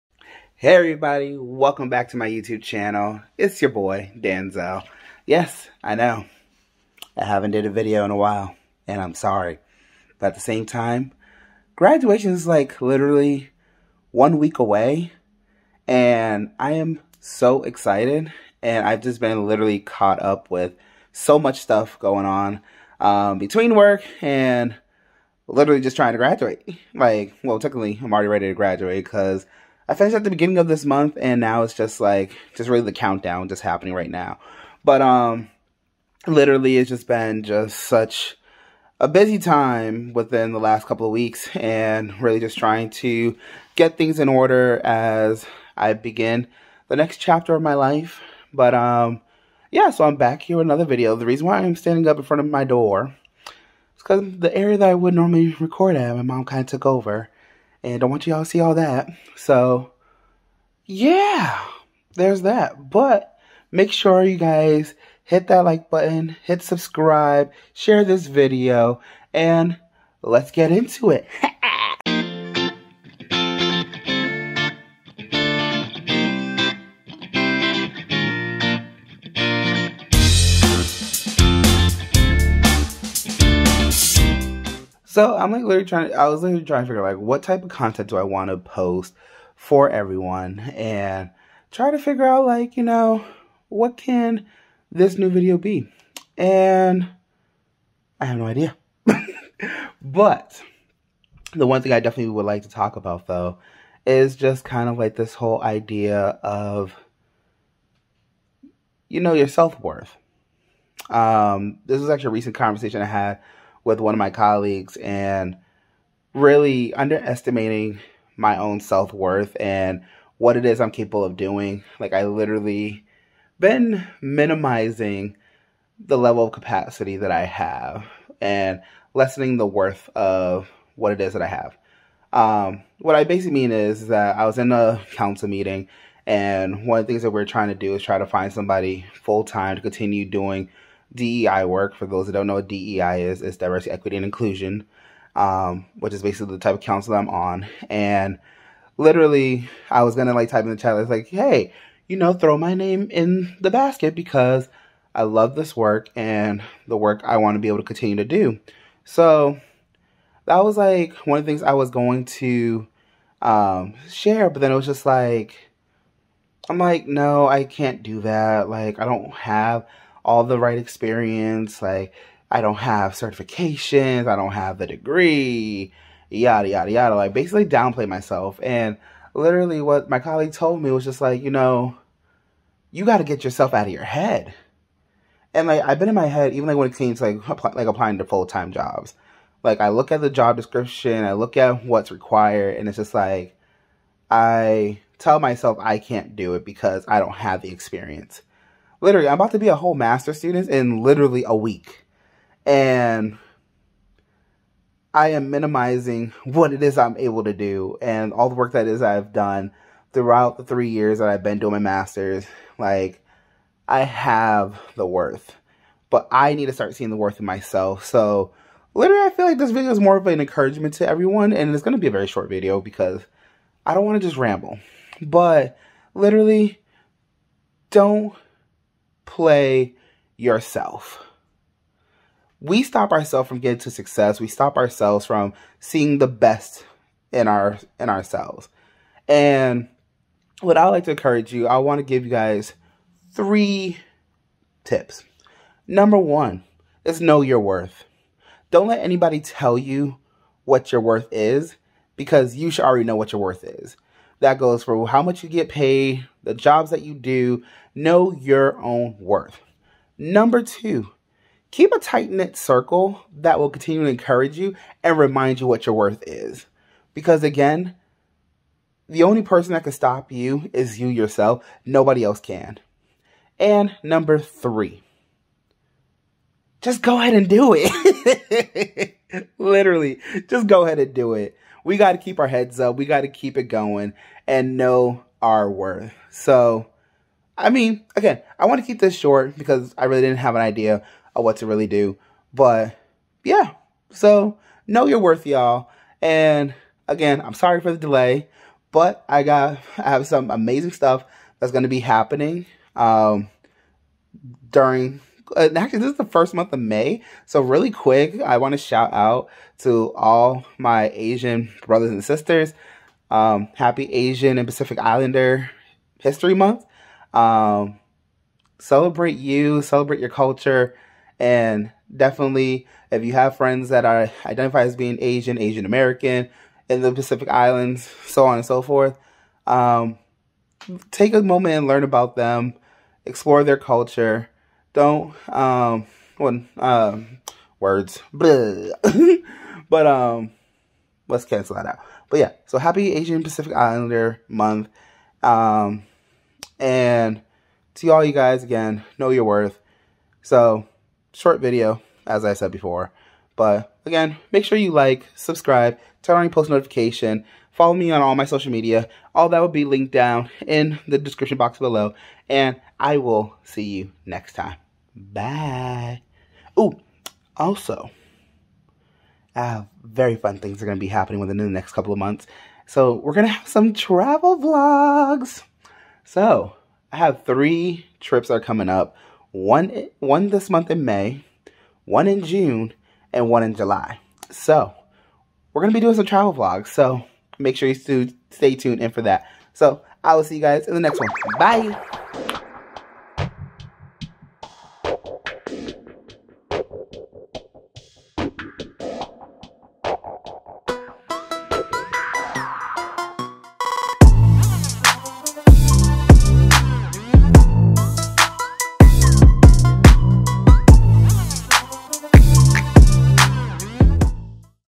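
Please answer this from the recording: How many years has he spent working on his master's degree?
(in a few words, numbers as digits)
3.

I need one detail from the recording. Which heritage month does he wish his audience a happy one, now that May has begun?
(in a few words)
Asian and Pacific Islander History Month.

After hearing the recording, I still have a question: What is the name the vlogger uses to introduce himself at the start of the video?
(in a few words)
Danzel.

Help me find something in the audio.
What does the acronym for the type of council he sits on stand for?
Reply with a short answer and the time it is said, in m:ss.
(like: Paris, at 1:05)
diversity, equity, and inclusion, at 2:23.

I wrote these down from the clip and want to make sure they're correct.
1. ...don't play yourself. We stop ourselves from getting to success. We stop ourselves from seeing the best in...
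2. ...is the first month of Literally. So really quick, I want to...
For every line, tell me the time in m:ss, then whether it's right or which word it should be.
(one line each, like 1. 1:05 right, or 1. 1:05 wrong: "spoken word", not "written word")
1. 3:47 right
2. 5:06 wrong: "May", not "Literally".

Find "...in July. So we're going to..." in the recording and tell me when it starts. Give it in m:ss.
6:23.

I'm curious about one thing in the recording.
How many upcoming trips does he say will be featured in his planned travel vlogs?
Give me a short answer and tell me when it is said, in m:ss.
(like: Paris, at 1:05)
3, at 6:17.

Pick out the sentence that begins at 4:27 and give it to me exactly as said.
Because again, the only person that can stop you is you yourself.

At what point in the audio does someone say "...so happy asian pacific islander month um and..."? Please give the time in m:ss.
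5:42.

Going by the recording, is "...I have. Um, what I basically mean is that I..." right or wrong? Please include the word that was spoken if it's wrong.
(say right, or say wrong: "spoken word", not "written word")
right.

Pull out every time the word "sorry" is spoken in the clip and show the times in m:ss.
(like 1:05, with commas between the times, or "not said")
0:09, 4:57.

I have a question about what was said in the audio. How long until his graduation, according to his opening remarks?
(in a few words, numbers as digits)
one week.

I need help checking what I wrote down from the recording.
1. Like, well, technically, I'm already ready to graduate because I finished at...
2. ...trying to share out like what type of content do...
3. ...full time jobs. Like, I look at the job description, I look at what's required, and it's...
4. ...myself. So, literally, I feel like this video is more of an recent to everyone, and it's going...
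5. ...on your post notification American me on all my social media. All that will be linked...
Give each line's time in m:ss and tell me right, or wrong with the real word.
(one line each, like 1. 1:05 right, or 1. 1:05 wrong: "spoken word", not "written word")
1. 0:26 right
2. 1:26 wrong: "figure", not "share"
3. 3:08 right
4. 3:37 wrong: "encouragement", not "recent"
5. 5:56 wrong: "Follow", not "American".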